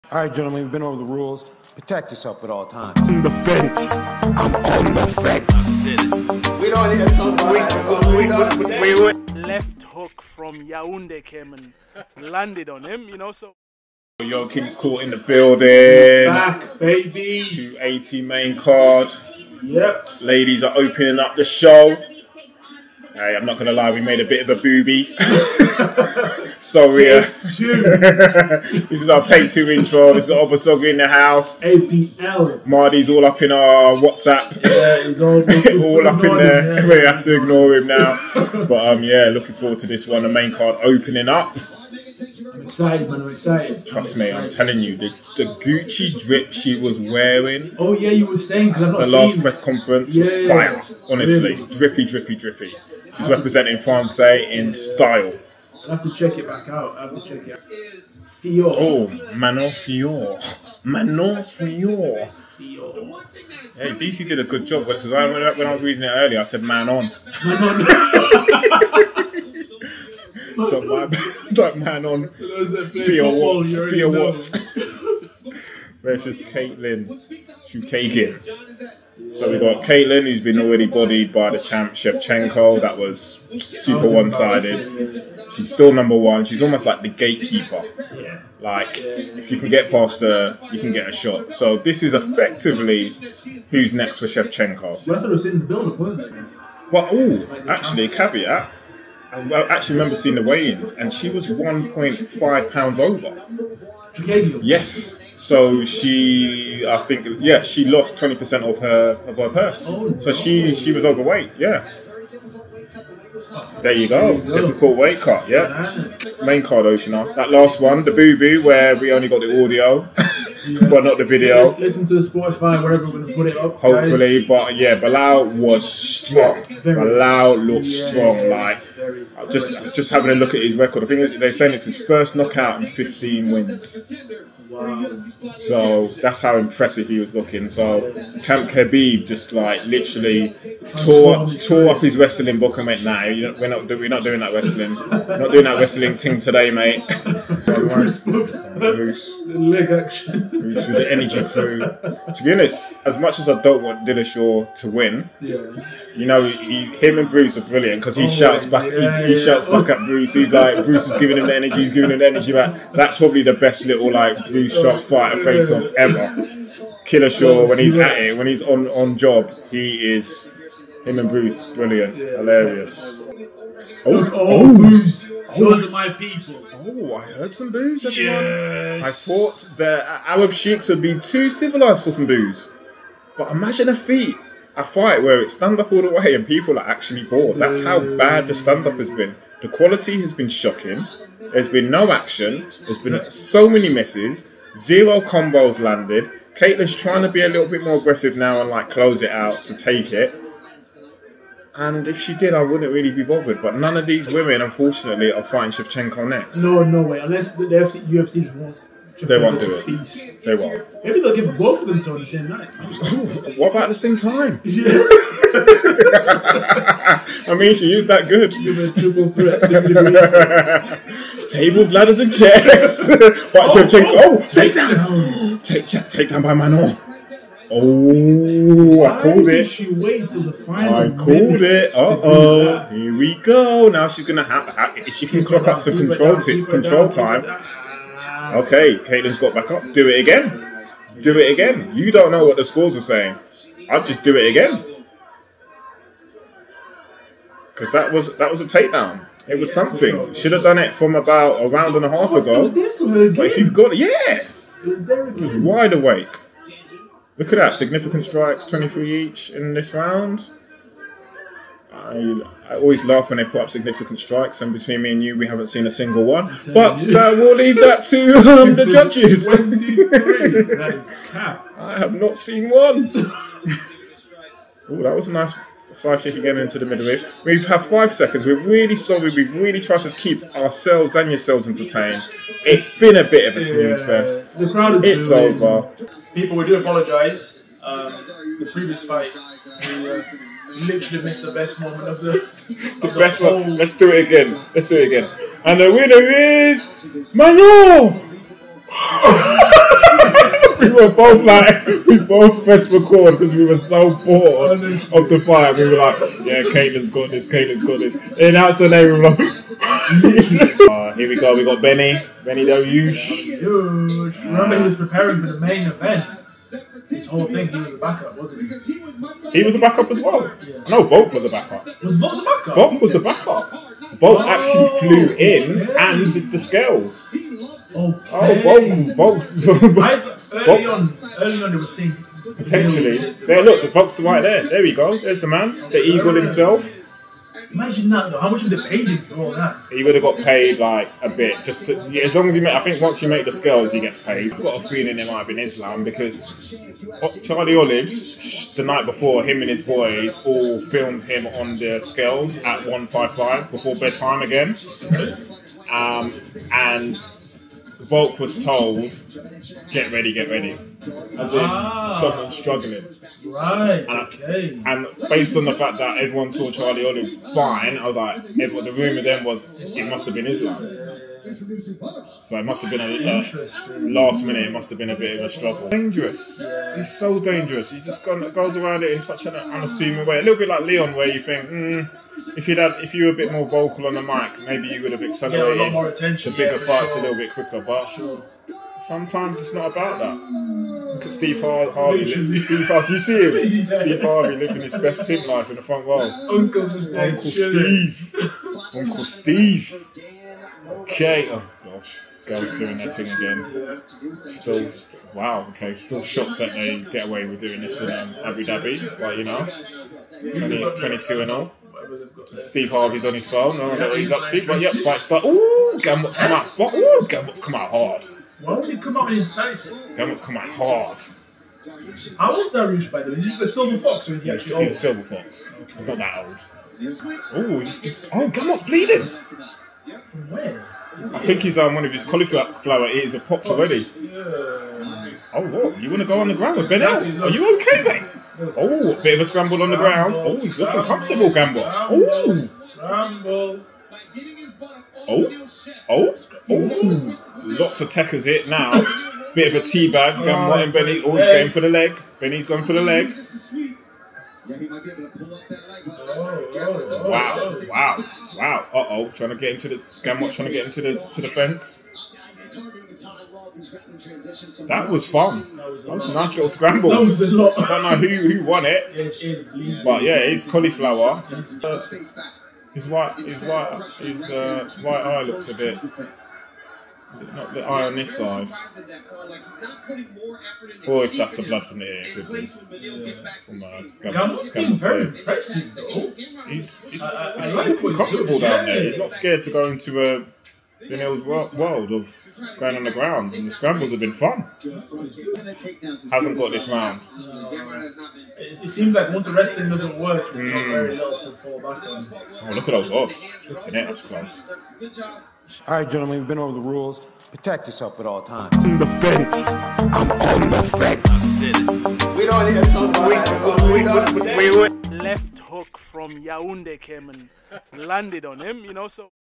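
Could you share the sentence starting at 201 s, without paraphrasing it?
And if she did, I wouldn't really be bothered.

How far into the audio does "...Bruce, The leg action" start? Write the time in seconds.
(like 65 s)
148 s.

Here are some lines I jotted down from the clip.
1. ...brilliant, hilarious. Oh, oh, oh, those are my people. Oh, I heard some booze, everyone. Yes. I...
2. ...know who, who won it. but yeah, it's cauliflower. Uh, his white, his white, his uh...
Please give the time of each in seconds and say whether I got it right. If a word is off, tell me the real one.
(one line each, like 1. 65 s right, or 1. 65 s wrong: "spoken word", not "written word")
1. 171 s right
2. 468 s right.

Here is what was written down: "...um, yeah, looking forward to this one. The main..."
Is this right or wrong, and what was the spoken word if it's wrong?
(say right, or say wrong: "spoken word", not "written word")
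right.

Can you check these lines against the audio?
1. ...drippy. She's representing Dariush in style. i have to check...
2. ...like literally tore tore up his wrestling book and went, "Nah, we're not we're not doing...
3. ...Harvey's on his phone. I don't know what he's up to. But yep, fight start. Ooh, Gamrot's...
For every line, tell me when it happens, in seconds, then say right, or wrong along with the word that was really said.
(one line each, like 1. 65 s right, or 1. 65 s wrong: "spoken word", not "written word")
1. 52 s wrong: "France", not "Dariush"
2. 139 s right
3. 412 s right.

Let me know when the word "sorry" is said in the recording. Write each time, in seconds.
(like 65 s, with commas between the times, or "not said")
26 s, 278 s.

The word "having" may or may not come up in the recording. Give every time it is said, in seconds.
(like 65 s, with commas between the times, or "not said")
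130 s.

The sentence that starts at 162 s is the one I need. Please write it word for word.
That's probably the best little like Bruce drop fighter face off ever.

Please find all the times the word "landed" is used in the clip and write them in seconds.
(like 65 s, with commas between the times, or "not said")
12 s, 195 s, 518 s.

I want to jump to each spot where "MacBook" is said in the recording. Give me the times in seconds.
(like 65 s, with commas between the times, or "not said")
not said.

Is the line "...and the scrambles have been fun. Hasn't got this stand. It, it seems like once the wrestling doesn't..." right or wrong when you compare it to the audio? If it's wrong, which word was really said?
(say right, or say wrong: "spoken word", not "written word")
wrong: "round", not "stand".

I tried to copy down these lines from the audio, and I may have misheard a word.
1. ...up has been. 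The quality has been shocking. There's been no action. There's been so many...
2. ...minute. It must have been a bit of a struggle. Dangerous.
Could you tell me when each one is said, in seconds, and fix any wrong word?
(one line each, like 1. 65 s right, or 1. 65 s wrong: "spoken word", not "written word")
1. 188 s right
2. 374 s right.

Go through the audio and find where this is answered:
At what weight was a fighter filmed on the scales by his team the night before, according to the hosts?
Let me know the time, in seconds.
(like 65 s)
352 s.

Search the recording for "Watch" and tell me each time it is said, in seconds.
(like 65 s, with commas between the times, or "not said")
223 s.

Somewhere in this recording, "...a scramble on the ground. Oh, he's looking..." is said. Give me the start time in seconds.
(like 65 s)
439 s.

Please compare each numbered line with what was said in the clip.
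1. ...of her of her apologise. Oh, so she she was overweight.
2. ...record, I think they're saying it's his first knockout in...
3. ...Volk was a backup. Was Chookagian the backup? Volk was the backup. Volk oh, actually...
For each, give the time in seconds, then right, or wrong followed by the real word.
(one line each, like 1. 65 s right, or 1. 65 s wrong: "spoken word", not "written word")
1. 108 s wrong: "purse", not "apologise"
2. 130 s right
3. 321 s wrong: "Volk", not "Chookagian".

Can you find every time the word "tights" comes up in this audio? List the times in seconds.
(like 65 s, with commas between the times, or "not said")
419 s.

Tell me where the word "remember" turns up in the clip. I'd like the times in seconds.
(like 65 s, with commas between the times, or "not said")
99 s, 314 s.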